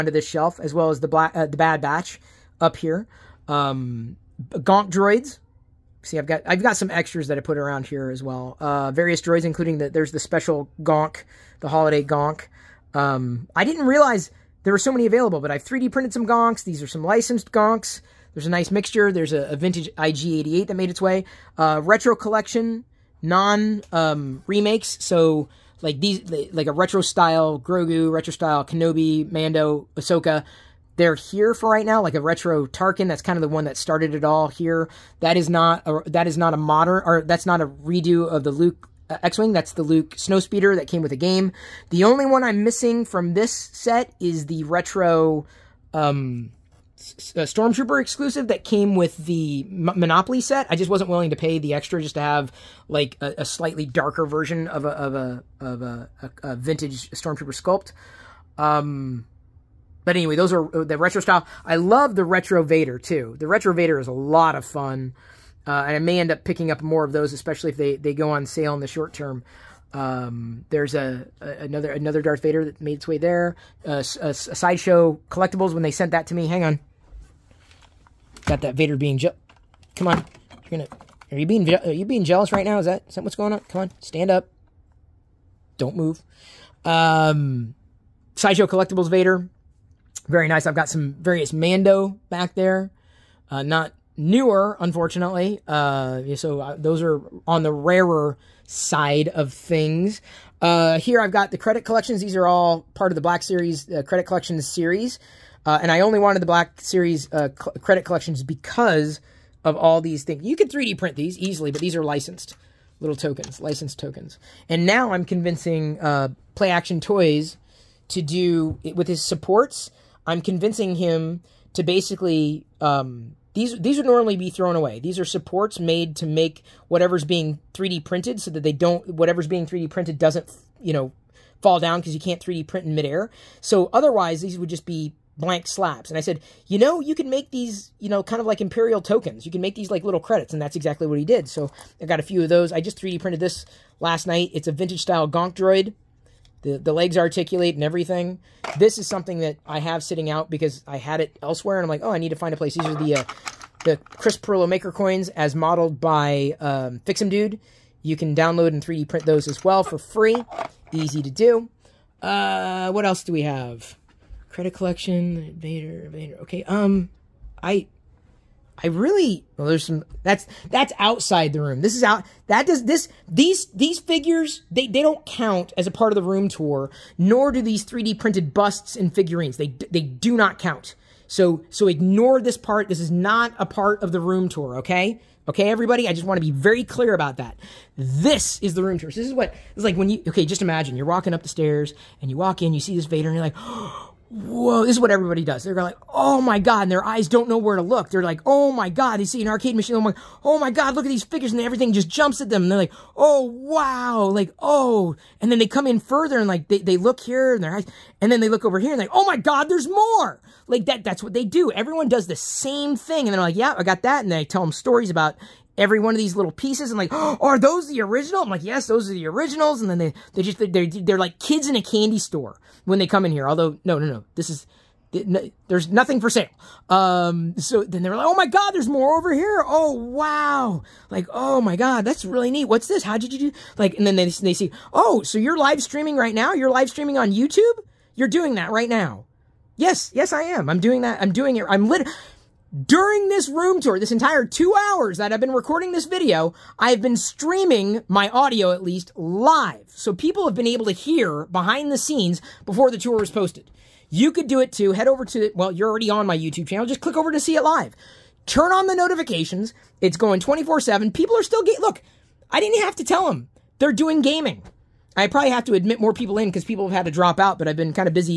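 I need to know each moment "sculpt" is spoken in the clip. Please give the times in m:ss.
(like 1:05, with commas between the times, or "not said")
0:57.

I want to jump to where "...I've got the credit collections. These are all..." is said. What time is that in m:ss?
1:41.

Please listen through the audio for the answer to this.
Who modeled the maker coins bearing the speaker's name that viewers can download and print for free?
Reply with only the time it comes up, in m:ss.
2:37.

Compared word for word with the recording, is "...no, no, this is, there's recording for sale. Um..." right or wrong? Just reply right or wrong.
wrong.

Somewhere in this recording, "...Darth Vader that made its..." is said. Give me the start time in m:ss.
1:12.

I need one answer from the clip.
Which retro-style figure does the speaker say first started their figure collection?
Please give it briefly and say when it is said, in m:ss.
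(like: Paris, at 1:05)
Tarkin, at 0:32.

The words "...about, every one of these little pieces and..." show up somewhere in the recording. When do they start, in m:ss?
3:35.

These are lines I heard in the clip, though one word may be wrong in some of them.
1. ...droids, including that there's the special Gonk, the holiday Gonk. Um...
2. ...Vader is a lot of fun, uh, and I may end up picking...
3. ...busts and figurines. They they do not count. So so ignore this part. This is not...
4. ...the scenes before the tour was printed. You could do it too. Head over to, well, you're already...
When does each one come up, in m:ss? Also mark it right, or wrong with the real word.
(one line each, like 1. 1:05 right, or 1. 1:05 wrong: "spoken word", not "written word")
1. 0:09 right
2. 1:03 right
3. 2:58 right
4. 4:11 wrong: "posted", not "printed".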